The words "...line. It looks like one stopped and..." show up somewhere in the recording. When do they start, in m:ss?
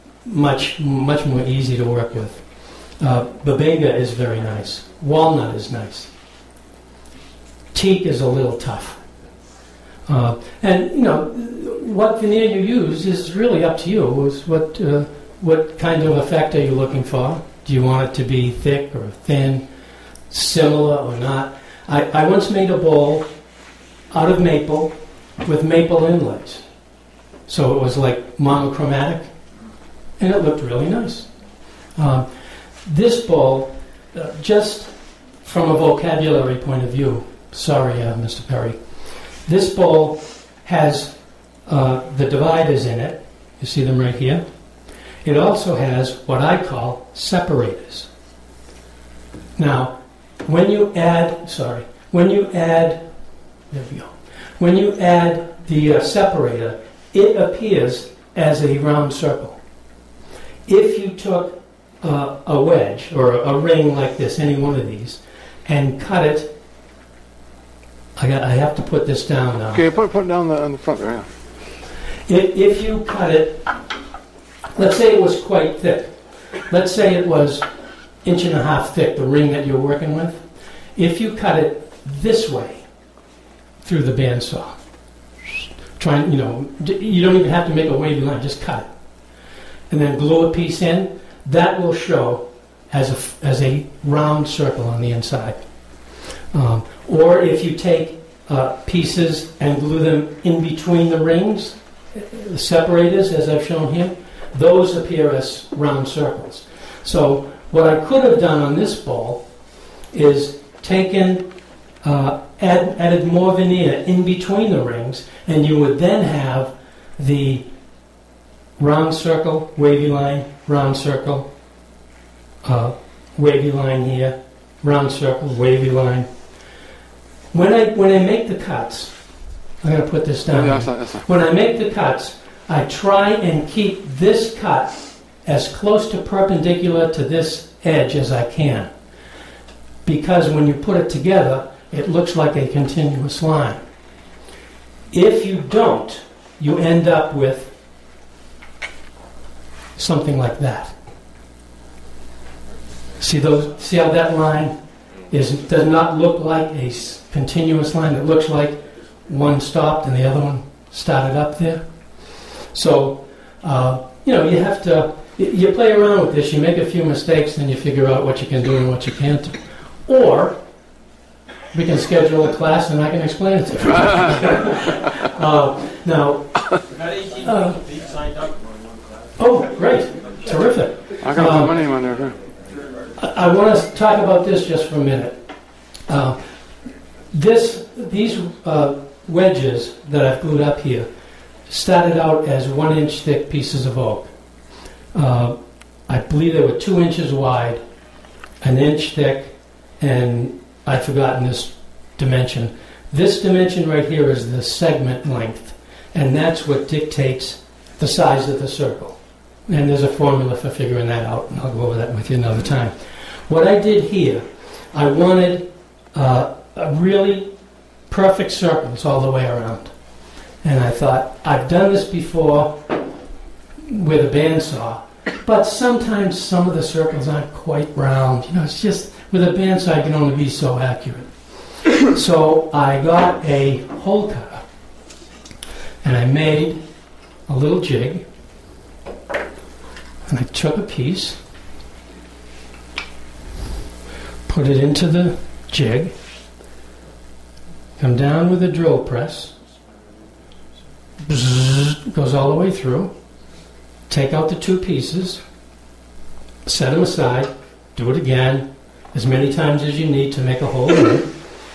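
2:37.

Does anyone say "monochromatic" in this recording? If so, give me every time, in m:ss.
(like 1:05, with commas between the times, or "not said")
0:28.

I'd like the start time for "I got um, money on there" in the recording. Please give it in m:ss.
3:01.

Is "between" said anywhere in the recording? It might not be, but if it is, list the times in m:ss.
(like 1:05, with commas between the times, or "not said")
1:40, 1:54.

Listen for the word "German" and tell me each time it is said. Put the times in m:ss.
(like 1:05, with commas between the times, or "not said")
not said.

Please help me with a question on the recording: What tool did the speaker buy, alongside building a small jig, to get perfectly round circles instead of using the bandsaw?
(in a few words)
hole cutter.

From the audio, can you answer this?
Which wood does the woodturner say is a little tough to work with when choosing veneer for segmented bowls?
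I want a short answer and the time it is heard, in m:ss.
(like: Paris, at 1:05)
teak, at 0:07.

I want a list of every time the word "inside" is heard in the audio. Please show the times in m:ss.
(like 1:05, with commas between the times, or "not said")
1:35.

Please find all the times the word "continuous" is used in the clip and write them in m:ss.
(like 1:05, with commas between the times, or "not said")
2:22, 2:37.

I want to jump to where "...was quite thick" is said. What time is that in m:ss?
1:15.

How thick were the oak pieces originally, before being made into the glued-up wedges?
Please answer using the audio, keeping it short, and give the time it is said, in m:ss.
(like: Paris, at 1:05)
1 inch, at 3:12.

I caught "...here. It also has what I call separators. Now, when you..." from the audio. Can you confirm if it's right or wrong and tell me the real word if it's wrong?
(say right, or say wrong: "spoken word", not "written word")
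right.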